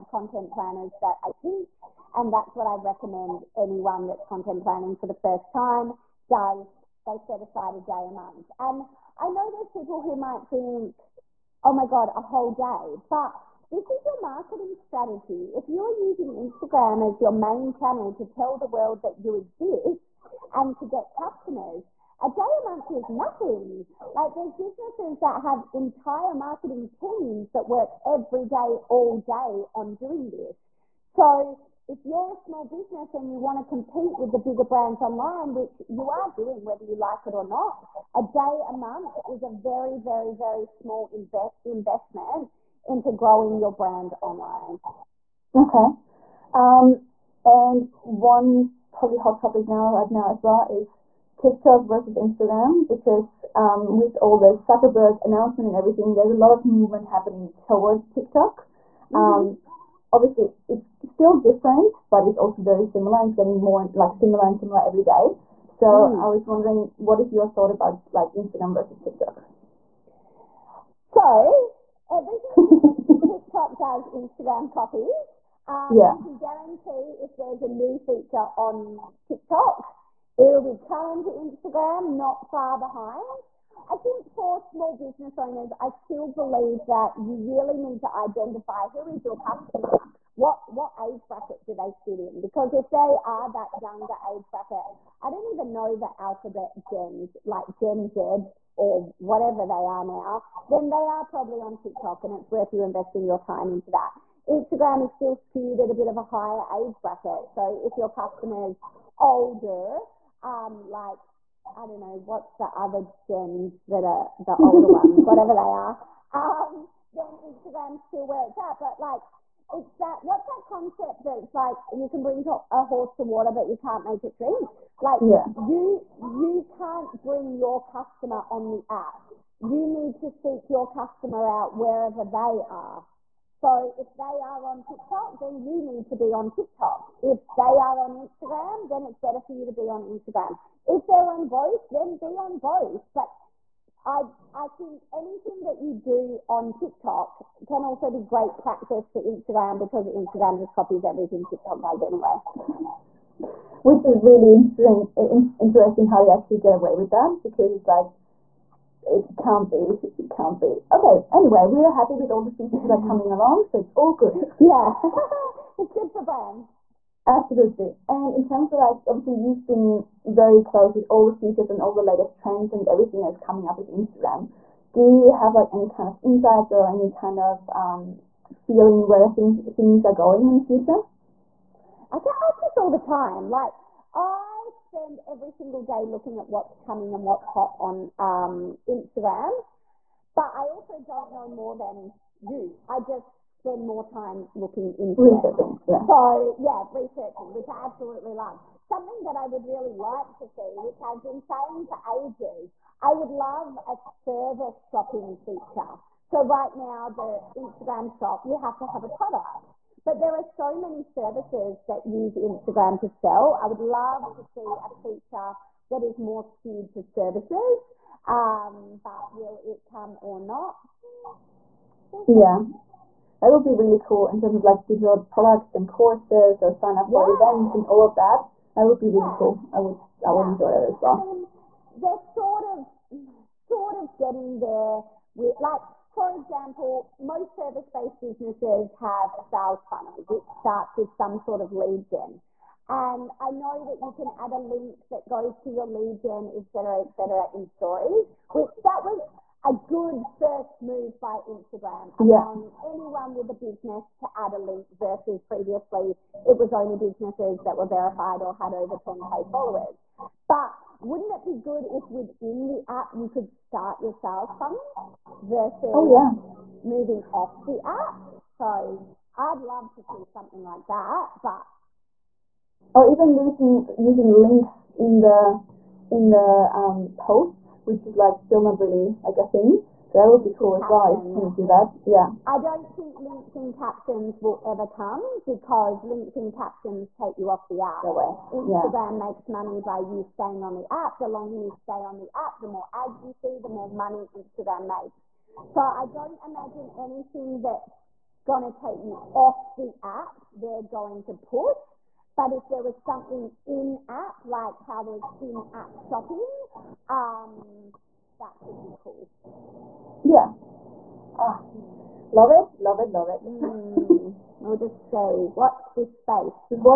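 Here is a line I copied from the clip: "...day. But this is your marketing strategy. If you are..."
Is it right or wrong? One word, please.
right.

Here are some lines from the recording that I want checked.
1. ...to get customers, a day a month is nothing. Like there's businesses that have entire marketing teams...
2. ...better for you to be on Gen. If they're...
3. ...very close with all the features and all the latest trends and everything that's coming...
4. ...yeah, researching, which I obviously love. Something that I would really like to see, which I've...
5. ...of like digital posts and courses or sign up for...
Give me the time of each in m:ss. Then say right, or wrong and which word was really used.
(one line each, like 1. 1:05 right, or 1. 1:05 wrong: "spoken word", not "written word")
1. 0:20 right
2. 2:19 wrong: "Instagram", not "Gen"
3. 2:50 right
4. 3:16 wrong: "absolutely", not "obviously"
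5. 3:44 wrong: "products", not "posts".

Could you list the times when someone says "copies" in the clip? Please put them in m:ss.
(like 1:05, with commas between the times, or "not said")
1:14, 2:30.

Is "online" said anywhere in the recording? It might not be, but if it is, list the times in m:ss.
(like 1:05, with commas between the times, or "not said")
0:35, 0:44.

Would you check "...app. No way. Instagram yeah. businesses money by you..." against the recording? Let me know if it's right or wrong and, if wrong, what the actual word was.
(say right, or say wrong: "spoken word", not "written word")
wrong: "makes", not "businesses".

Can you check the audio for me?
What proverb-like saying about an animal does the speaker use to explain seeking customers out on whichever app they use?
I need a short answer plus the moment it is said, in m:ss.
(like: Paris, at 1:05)
bring a horse to water, at 2:02.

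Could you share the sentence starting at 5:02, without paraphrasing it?
But if there was something in app, like how there's in app shopping, um, that could be cool.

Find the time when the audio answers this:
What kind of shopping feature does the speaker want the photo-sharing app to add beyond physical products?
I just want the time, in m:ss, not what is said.
3:24.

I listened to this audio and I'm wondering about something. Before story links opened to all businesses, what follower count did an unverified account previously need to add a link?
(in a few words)
10K.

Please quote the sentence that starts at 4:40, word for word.
So that would be cool as well if you can do that.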